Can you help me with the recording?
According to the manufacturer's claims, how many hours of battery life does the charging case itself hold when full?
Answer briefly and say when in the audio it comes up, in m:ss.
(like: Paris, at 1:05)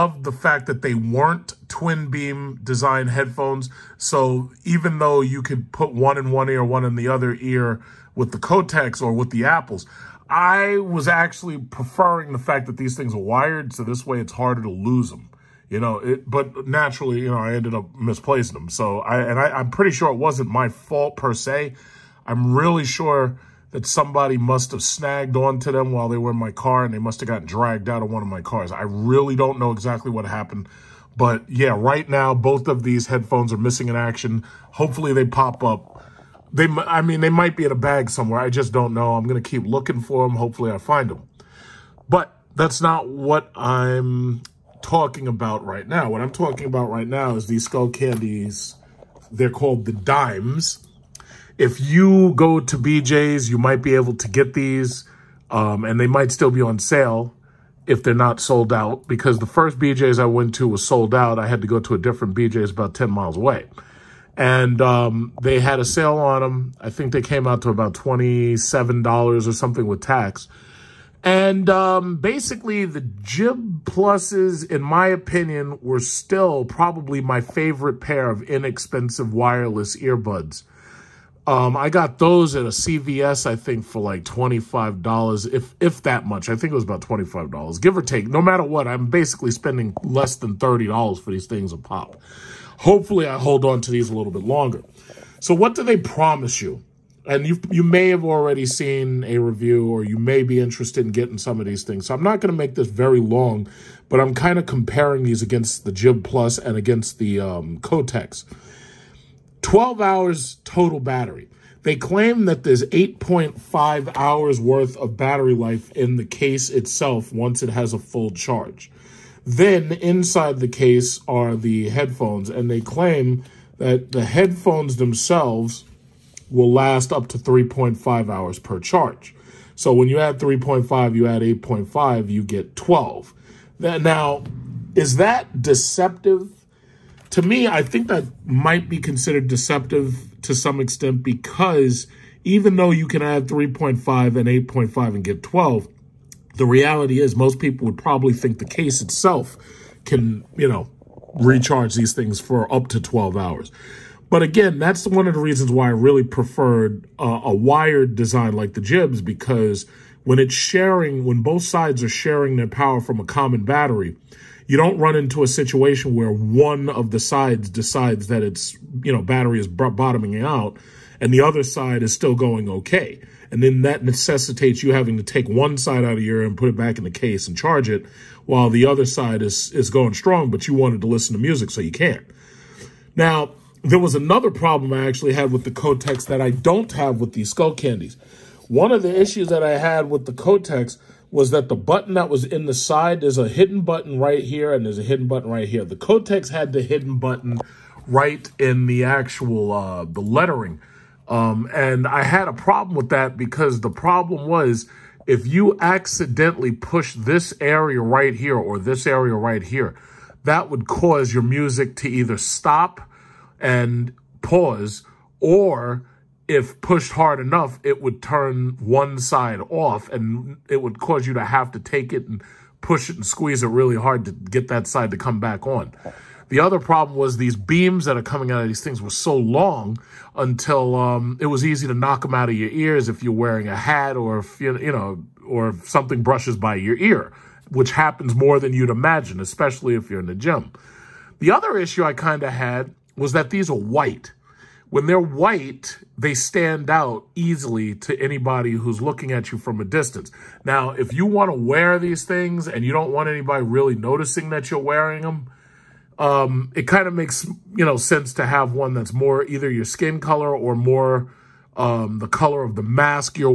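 8.5, at 1:52.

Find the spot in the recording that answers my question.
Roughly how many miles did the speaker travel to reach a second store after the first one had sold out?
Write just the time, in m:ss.
1:02.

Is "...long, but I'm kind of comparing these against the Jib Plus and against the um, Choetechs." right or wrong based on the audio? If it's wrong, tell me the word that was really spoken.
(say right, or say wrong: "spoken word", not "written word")
right.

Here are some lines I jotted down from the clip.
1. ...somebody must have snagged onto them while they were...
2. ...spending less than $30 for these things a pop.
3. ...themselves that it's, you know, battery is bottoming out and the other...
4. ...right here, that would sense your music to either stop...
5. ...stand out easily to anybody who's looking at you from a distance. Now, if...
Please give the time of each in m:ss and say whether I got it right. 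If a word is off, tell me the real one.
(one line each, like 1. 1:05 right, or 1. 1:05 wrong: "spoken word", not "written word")
1. 0:23 right
2. 1:29 right
3. 2:47 wrong: "decides", not "themselves"
4. 3:29 wrong: "cause", not "sense"
5. 4:06 right.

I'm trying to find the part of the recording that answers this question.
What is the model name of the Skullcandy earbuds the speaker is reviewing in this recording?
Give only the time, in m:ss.
0:49.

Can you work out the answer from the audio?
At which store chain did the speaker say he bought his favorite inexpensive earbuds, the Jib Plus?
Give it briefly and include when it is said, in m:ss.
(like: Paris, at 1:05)
CVS, at 1:22.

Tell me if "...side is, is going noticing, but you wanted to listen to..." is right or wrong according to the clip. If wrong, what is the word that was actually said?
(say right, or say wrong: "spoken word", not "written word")
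wrong: "strong", not "noticing".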